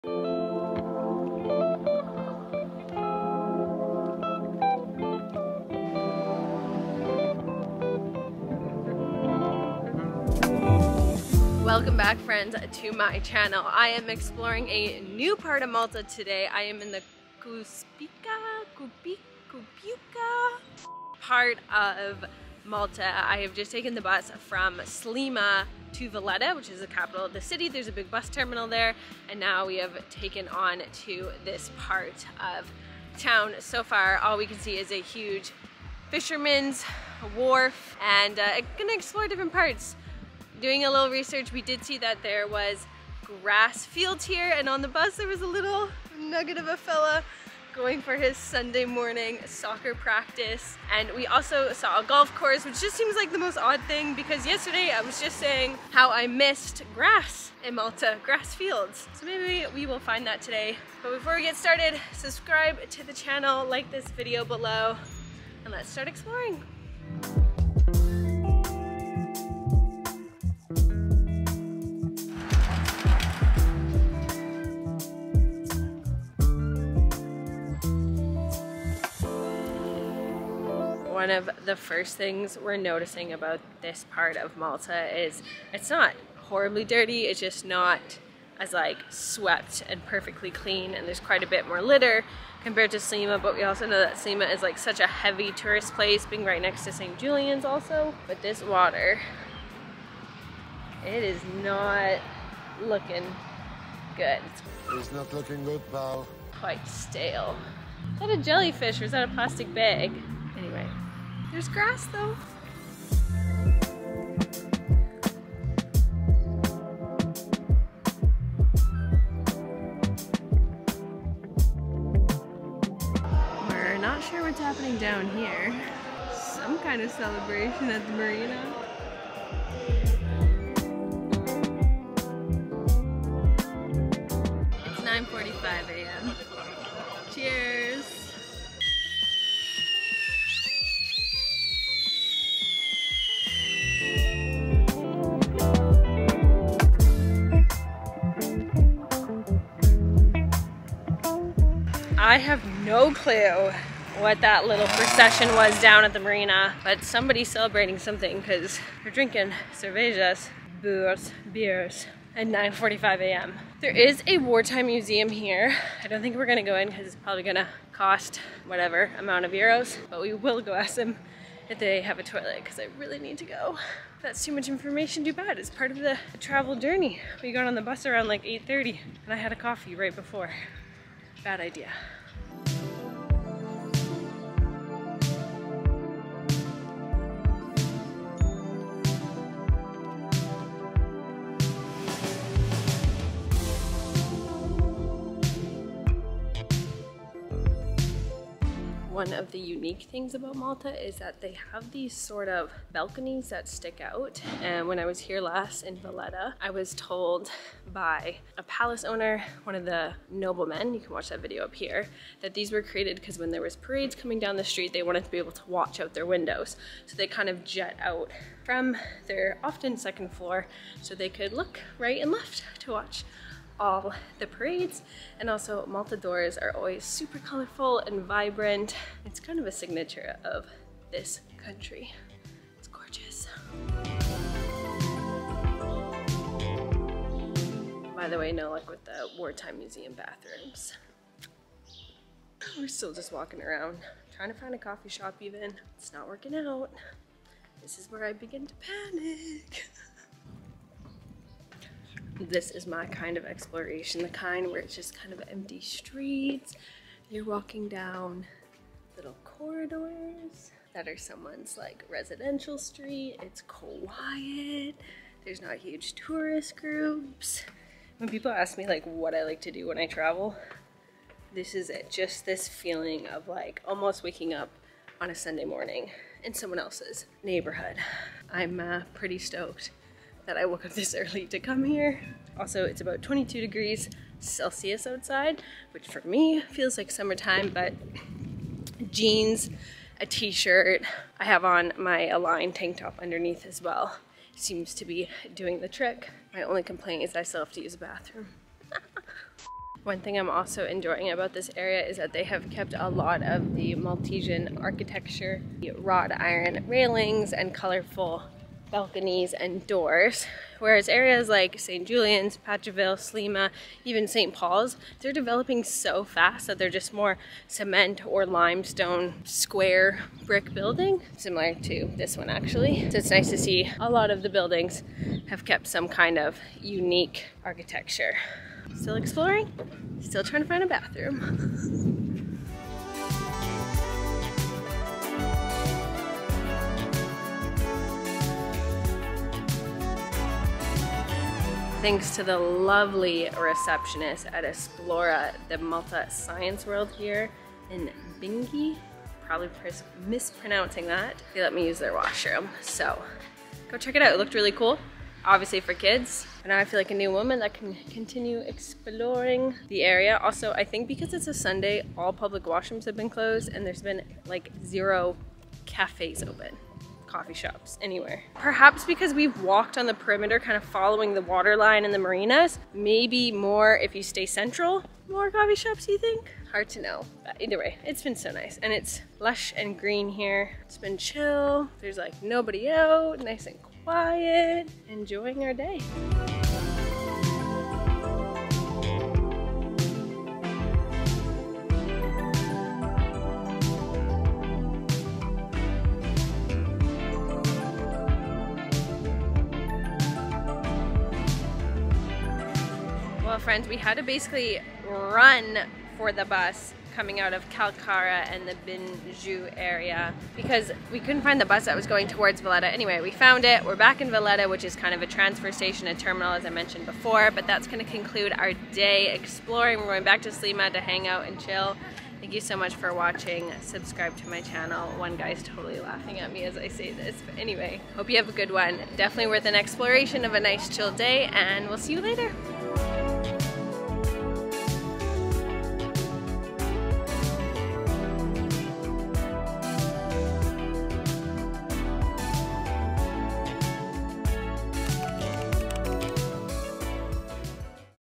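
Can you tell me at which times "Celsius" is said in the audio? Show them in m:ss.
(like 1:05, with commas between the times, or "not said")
4:44.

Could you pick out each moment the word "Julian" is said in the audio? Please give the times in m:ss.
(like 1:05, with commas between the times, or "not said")
1:37, 5:12.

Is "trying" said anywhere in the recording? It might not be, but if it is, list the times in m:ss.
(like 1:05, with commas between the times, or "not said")
4:04, 5:30.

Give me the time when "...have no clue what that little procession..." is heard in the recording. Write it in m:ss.
2:32.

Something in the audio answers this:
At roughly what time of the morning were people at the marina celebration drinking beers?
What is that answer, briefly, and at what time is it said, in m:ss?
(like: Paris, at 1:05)
9:45 a.m., at 2:42.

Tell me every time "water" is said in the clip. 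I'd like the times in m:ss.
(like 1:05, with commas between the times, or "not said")
1:38, 6:11.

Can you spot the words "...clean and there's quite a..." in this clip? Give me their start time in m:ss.
1:30.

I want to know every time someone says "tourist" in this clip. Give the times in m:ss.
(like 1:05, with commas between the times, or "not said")
1:35, 4:26.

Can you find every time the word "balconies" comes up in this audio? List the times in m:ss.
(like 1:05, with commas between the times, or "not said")
3:22, 5:08.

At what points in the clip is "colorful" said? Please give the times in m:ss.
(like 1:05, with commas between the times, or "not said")
3:47, 5:07.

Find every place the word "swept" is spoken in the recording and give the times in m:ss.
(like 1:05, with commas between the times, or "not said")
1:29.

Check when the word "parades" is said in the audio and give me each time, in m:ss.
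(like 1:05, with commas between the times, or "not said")
3:33, 3:44.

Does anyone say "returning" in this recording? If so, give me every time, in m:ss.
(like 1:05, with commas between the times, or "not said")
not said.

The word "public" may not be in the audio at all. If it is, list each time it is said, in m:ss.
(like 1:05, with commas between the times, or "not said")
6:02.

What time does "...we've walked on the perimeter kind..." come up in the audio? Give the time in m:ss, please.
6:09.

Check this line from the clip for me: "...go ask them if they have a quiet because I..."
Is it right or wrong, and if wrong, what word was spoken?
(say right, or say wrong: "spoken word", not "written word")
wrong: "toilet", not "quiet".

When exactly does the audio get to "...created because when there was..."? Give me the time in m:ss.
3:32.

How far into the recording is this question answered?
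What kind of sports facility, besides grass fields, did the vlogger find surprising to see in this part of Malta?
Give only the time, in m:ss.
0:52.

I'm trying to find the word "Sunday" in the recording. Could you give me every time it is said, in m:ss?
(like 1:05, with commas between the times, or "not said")
0:48, 4:35, 6:01.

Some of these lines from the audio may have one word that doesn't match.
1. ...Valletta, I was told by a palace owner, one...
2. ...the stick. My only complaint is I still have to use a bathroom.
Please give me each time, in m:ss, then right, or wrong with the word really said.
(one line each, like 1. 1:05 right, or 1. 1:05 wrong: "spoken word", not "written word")
1. 3:25 right
2. 4:55 wrong: "trick", not "stick".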